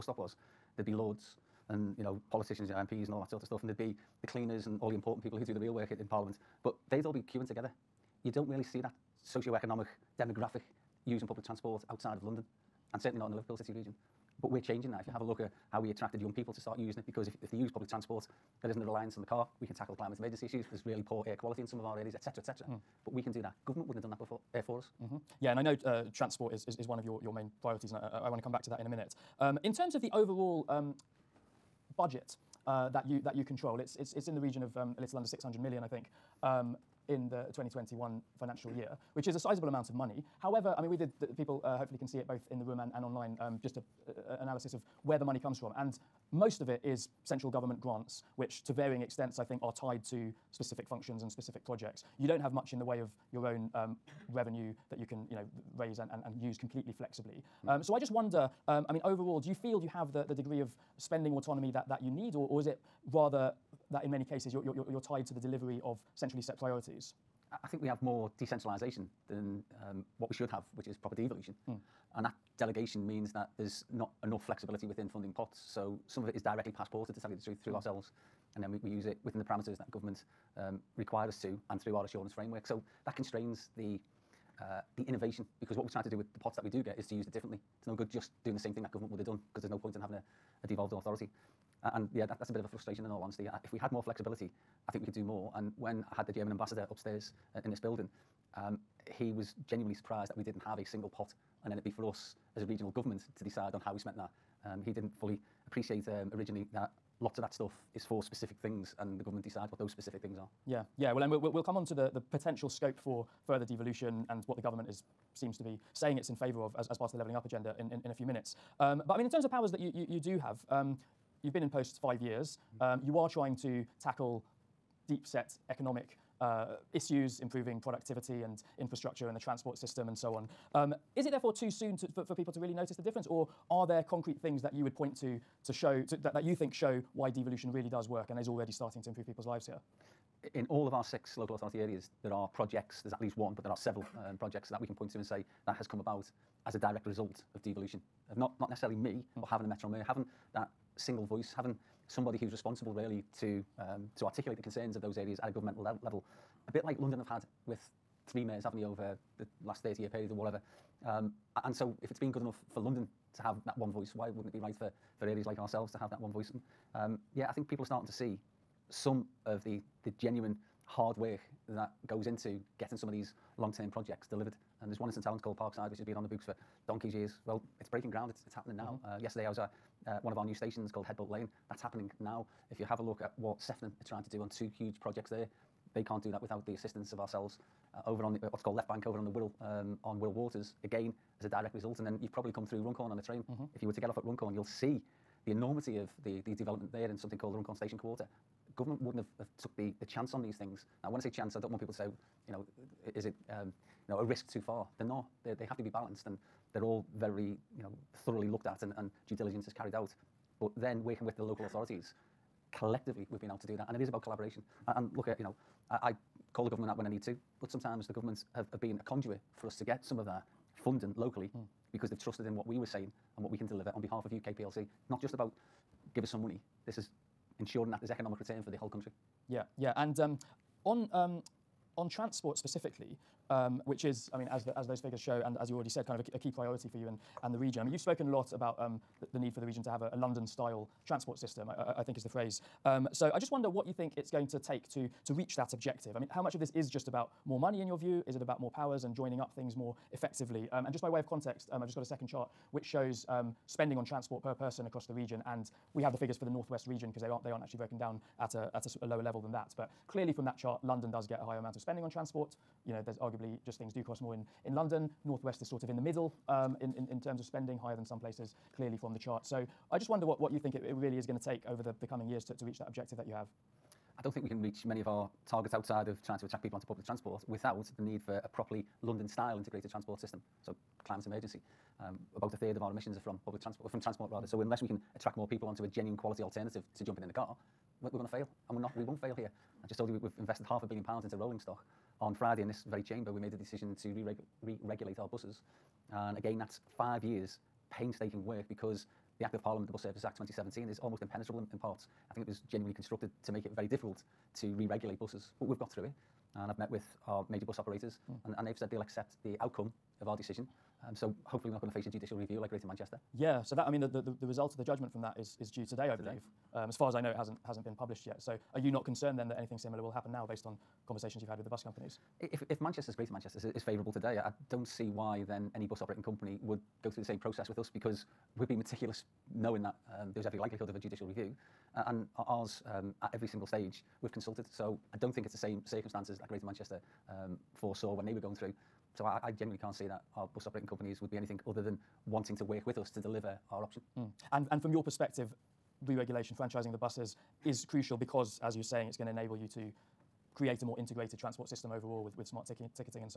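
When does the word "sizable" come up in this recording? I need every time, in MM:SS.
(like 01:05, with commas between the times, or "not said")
00:39.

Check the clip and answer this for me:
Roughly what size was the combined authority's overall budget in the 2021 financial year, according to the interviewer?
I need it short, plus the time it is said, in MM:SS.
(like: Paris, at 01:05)
a little under 600 million, at 00:34.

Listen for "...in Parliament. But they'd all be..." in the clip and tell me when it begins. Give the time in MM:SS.
00:05.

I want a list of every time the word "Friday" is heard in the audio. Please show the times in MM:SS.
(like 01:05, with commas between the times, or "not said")
04:52.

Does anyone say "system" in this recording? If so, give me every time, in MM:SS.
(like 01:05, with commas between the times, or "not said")
02:09, 04:01, 04:40, 05:51.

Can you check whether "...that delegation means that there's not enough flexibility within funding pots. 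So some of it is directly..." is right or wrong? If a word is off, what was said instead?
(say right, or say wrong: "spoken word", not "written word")
right.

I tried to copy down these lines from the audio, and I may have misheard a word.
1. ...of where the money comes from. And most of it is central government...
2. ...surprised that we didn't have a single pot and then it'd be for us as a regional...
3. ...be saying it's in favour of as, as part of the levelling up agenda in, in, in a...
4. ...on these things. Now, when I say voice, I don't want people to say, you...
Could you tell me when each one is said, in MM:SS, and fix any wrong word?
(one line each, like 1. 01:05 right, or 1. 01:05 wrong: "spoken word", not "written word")
1. 00:44 right
2. 01:39 right
3. 01:55 right
4. 03:20 wrong: "chance", not "voice".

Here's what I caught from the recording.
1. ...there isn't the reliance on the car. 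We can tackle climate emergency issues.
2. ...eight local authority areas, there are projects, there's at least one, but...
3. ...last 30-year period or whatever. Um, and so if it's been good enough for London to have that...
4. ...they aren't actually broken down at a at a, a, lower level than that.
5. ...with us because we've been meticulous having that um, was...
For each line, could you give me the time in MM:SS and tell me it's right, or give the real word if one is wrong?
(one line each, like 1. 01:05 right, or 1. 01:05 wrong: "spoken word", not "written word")
1. 00:18 right
2. 02:21 wrong: "six", not "eight"
3. 02:39 right
4. 04:17 right
5. 05:27 wrong: "knowing", not "having".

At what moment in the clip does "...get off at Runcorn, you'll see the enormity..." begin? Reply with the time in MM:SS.
03:13.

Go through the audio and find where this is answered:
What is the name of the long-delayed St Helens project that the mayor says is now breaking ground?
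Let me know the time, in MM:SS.
02:55.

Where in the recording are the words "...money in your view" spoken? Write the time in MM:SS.
04:07.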